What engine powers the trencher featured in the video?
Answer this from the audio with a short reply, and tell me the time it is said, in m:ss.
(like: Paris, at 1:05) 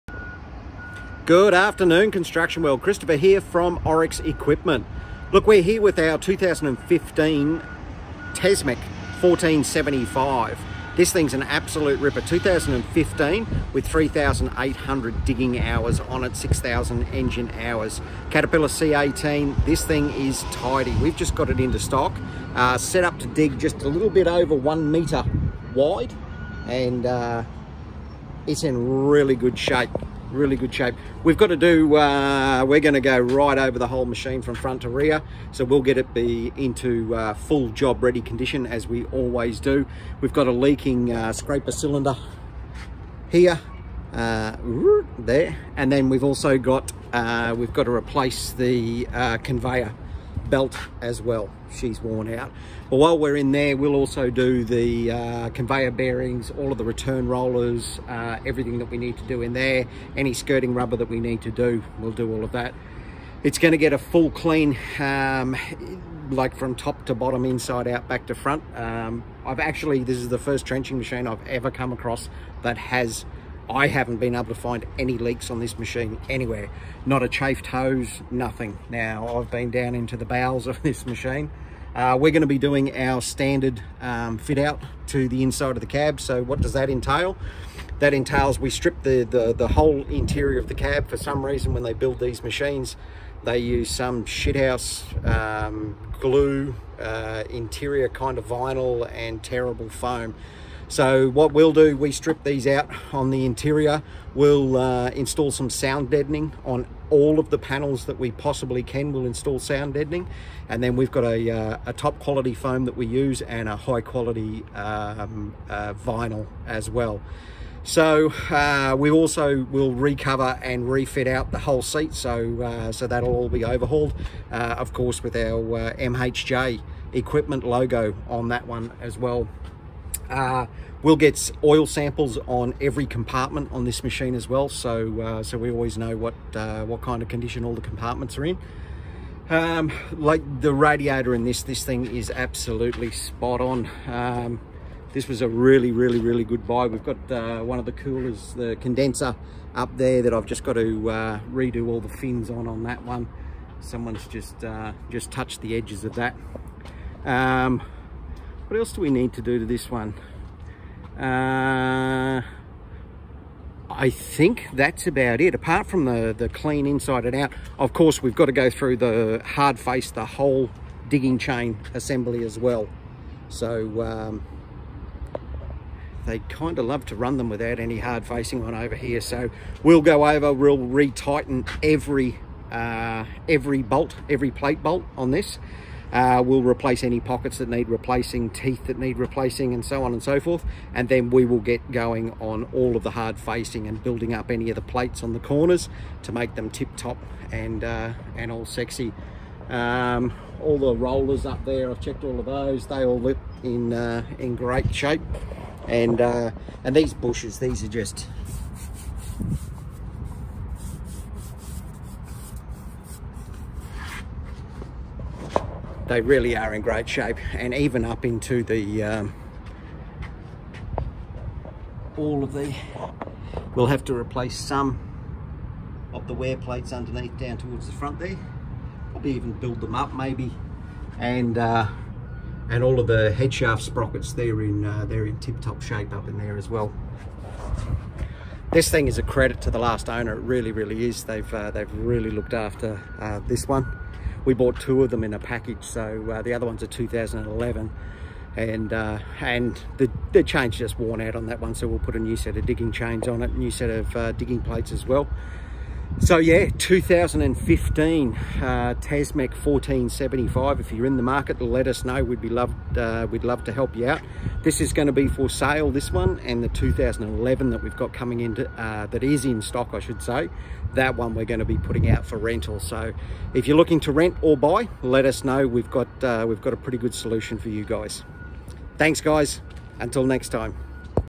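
Caterpillar C18, at 0:18.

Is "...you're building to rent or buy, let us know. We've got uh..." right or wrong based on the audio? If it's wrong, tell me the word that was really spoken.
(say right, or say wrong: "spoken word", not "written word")
wrong: "looking", not "building".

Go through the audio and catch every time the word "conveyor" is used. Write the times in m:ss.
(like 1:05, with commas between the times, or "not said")
0:49, 0:55.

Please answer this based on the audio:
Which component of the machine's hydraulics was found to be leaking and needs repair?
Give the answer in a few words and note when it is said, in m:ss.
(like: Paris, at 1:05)
scraper cylinder, at 0:41.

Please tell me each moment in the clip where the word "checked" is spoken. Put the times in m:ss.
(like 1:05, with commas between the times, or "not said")
3:22.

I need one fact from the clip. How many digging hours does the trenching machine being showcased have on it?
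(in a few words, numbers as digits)
3,800.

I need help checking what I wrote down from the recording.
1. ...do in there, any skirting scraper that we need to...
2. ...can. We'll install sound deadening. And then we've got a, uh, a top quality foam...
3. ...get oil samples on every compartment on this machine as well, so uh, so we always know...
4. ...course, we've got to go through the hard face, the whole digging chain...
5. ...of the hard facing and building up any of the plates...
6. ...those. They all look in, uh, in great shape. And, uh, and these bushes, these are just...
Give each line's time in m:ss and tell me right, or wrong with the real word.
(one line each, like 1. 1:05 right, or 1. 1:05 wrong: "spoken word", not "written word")
1. 0:59 wrong: "rubber", not "scraper"
2. 1:48 right
3. 2:11 right
4. 2:47 right
5. 3:12 right
6. 3:22 right.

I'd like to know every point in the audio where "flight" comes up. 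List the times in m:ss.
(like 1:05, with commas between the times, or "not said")
not said.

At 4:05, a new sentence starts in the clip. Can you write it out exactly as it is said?
So uh, the other one's a 2011 and uh, and the, the chain's just worn out on that one.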